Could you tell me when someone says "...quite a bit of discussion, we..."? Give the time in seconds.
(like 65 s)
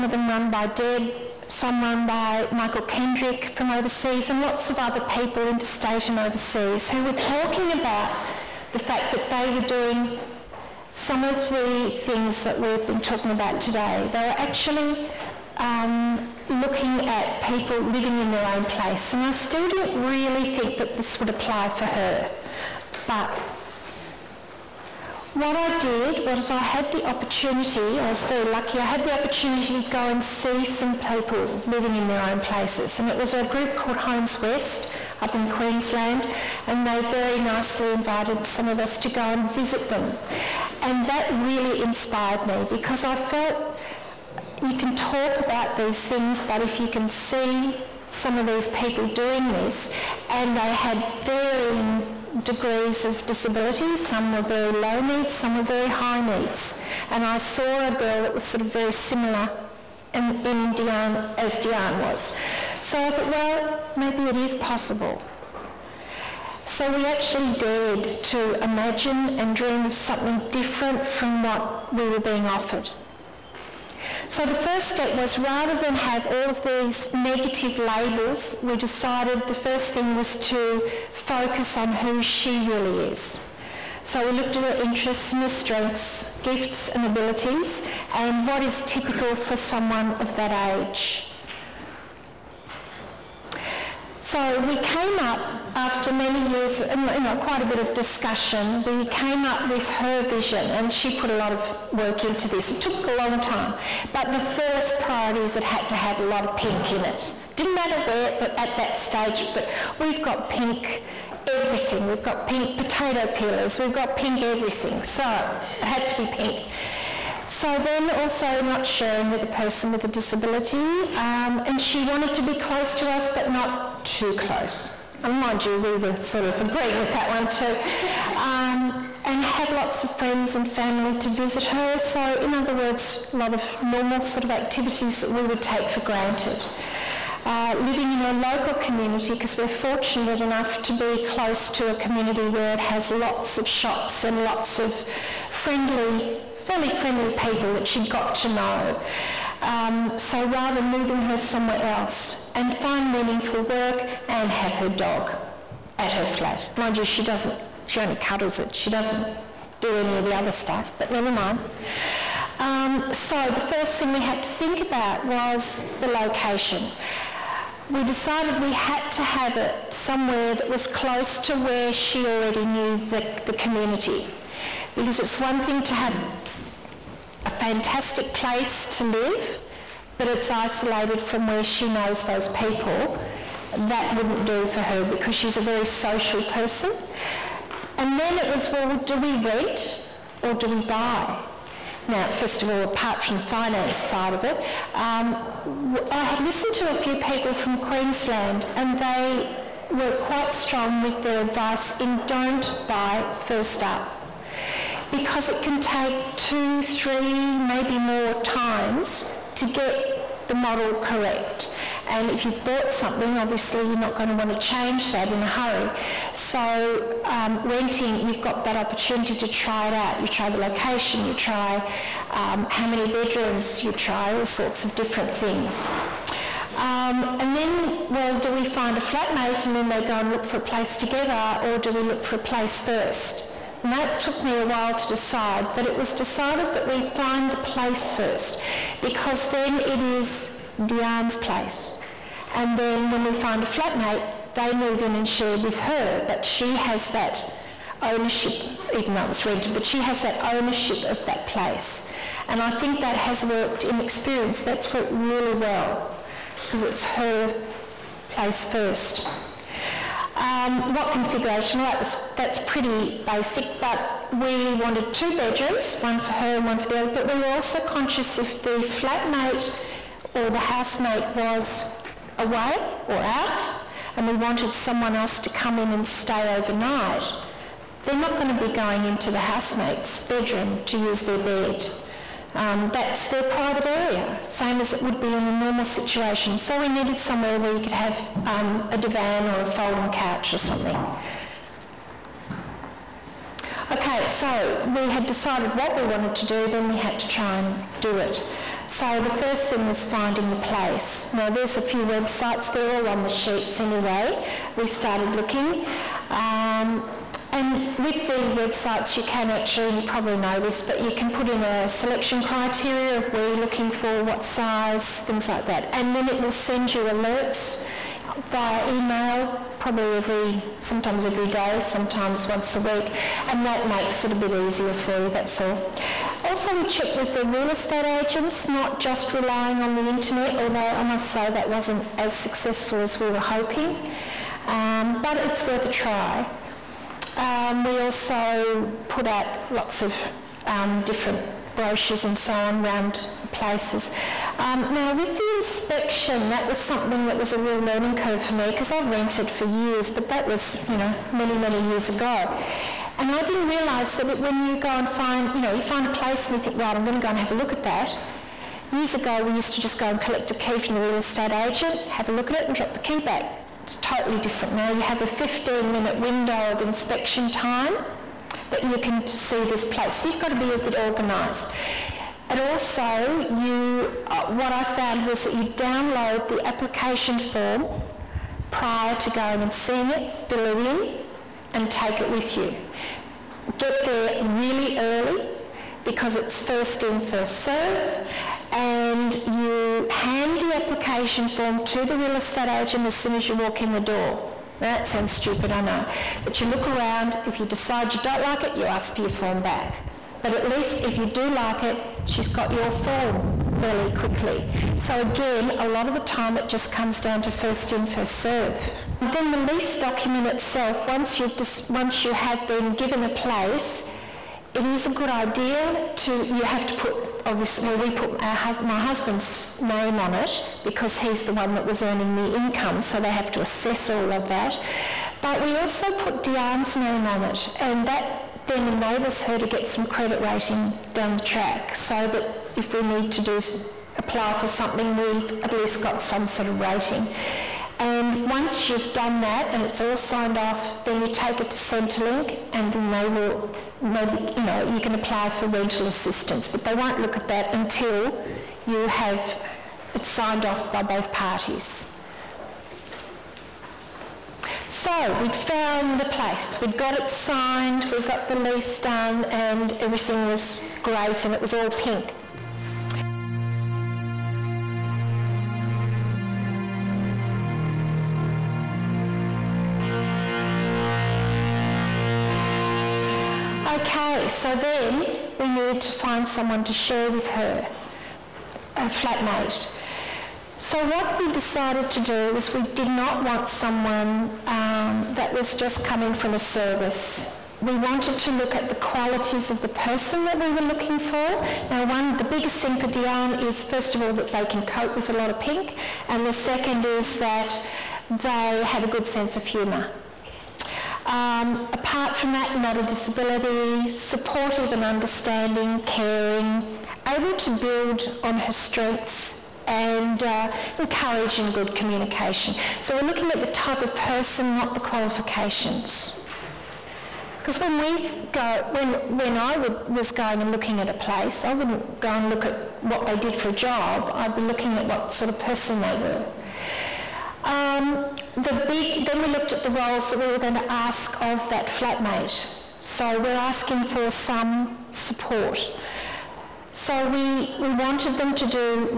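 97 s.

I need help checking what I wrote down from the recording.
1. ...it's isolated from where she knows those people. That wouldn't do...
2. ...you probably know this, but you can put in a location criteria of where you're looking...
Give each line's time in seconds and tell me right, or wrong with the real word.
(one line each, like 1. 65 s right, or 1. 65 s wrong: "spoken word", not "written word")
1. 180 s right
2. 309 s wrong: "selection", not "location".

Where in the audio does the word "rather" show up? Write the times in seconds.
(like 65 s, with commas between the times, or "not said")
75 s, 150 s.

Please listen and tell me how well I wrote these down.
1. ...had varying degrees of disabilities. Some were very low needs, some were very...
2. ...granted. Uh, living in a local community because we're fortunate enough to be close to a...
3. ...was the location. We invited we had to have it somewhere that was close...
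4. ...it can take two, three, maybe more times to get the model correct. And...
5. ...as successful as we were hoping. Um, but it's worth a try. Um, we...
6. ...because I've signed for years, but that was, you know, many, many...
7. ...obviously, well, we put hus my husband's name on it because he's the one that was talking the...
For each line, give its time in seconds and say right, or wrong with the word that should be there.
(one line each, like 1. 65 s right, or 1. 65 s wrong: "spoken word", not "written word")
1. 50 s right
2. 136 s right
3. 165 s wrong: "decided", not "invited"
4. 205 s right
5. 332 s right
6. 348 s wrong: "rented", not "signed"
7. 417 s wrong: "earning", not "talking".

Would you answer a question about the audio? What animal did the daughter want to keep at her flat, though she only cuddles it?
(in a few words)
Dog.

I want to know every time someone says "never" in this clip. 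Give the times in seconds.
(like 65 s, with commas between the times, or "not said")
161 s.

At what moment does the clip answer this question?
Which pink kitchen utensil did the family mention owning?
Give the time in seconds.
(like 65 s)
112 s.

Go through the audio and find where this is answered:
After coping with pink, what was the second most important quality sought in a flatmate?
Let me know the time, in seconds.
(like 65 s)
499 s.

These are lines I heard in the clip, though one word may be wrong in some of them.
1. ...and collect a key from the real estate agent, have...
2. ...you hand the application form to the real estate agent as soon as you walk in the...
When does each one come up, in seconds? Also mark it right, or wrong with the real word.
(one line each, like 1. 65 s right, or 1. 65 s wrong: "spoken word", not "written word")
1. 360 s right
2. 389 s right.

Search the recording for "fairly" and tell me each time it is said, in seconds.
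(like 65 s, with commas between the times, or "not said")
146 s, 403 s.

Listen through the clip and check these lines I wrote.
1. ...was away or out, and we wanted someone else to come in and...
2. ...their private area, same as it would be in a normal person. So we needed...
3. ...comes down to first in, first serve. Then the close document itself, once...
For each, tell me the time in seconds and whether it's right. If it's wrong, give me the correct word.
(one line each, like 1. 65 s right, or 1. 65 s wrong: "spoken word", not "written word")
1. 271 s right
2. 283 s wrong: "situation", not "person"
3. 406 s wrong: "lease", not "close".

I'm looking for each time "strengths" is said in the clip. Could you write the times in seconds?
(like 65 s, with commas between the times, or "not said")
85 s, 508 s.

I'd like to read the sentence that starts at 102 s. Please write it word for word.
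It took a long time, but the first priority is it had to have a lot of pink in it.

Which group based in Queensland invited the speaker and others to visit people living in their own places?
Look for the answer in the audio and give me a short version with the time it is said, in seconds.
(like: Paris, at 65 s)
Homes West, at 33 s.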